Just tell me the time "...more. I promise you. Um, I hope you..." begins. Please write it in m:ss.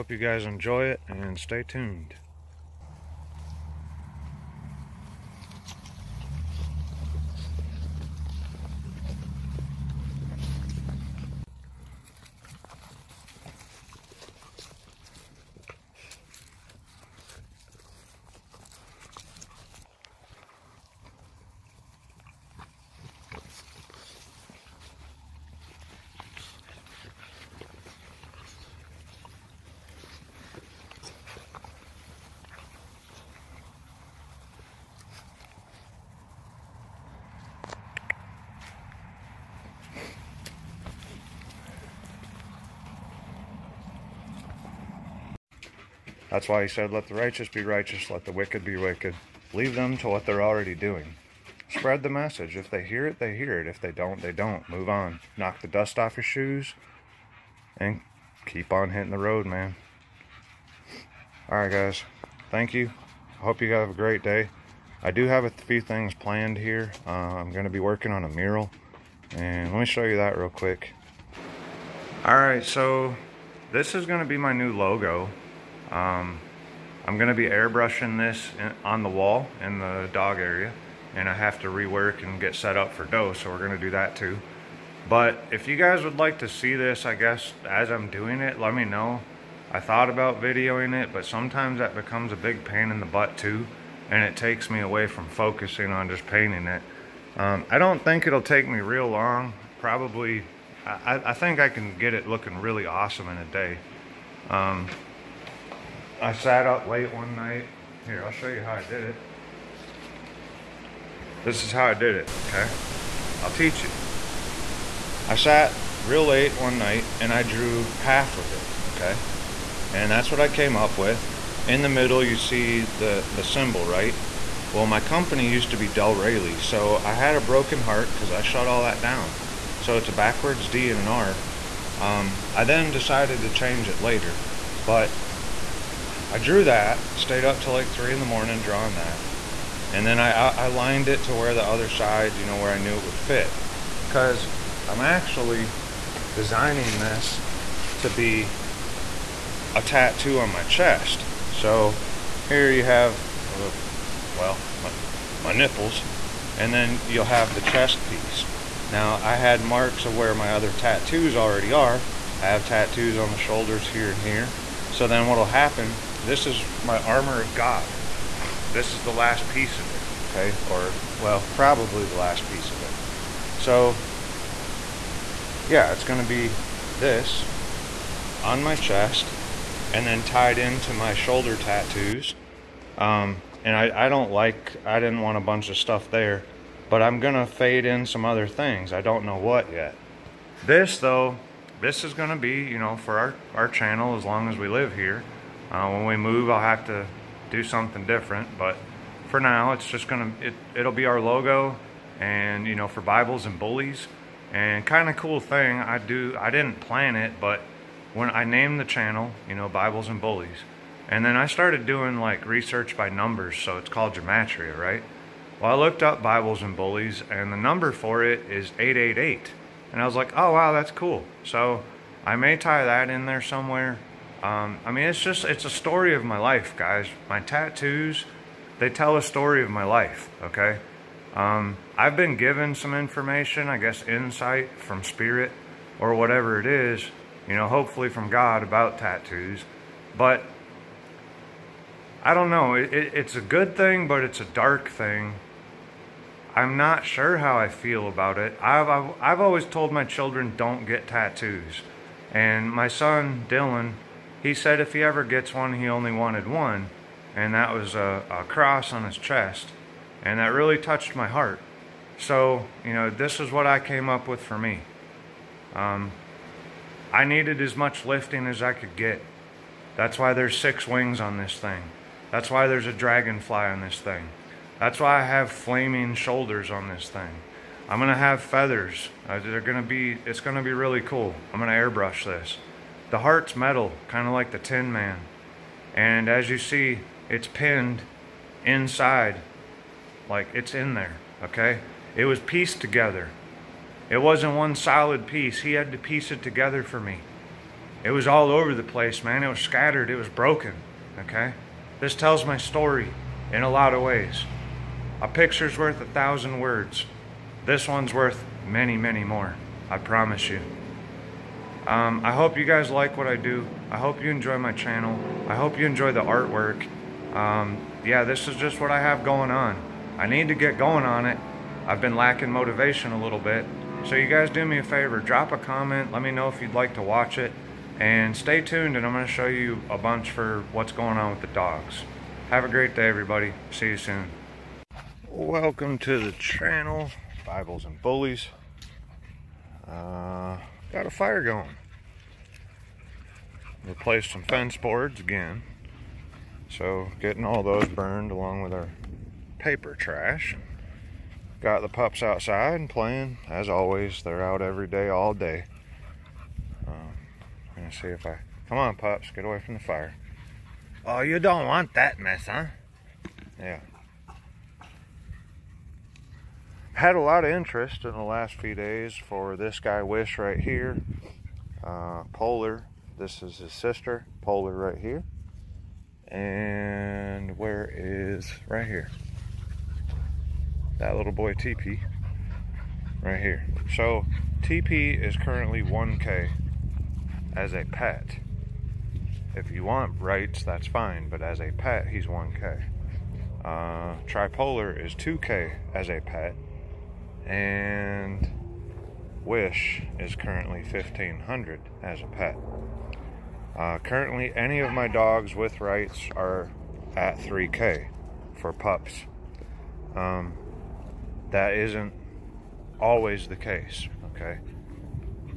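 5:09.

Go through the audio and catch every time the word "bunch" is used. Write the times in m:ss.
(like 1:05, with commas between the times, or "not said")
3:05, 5:29.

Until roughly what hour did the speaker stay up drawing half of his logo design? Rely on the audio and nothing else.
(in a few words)
3 in the morning.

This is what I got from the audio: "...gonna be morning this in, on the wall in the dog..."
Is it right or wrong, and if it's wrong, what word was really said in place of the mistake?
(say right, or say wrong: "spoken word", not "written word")
wrong: "airbrushing", not "morning".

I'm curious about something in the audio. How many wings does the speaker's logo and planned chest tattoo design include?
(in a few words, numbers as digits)
6.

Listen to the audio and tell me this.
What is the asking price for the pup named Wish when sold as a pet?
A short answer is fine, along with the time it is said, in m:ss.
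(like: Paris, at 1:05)
1500, at 6:40.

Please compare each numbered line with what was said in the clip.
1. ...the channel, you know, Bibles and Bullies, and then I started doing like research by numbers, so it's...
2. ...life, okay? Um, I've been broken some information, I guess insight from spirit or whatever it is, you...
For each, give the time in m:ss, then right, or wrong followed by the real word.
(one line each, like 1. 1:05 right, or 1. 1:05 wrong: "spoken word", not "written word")
1. 3:28 right
2. 3:49 wrong: "given", not "broken".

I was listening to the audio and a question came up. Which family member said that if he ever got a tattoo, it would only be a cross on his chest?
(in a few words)
Dylan.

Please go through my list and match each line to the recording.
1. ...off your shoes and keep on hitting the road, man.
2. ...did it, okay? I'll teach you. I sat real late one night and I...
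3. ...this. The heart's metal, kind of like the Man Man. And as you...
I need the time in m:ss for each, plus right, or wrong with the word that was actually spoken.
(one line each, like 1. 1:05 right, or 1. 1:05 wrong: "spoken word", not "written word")
1. 0:55 right
2. 1:51 right
3. 4:42 wrong: "Tin", not "Man".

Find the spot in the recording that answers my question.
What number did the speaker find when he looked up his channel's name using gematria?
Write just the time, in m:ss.
3:38.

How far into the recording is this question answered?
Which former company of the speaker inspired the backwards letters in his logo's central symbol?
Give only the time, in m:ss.
2:05.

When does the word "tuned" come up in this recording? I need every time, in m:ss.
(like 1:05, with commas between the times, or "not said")
0:01, 5:28.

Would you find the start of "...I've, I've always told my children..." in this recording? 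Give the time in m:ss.
4:08.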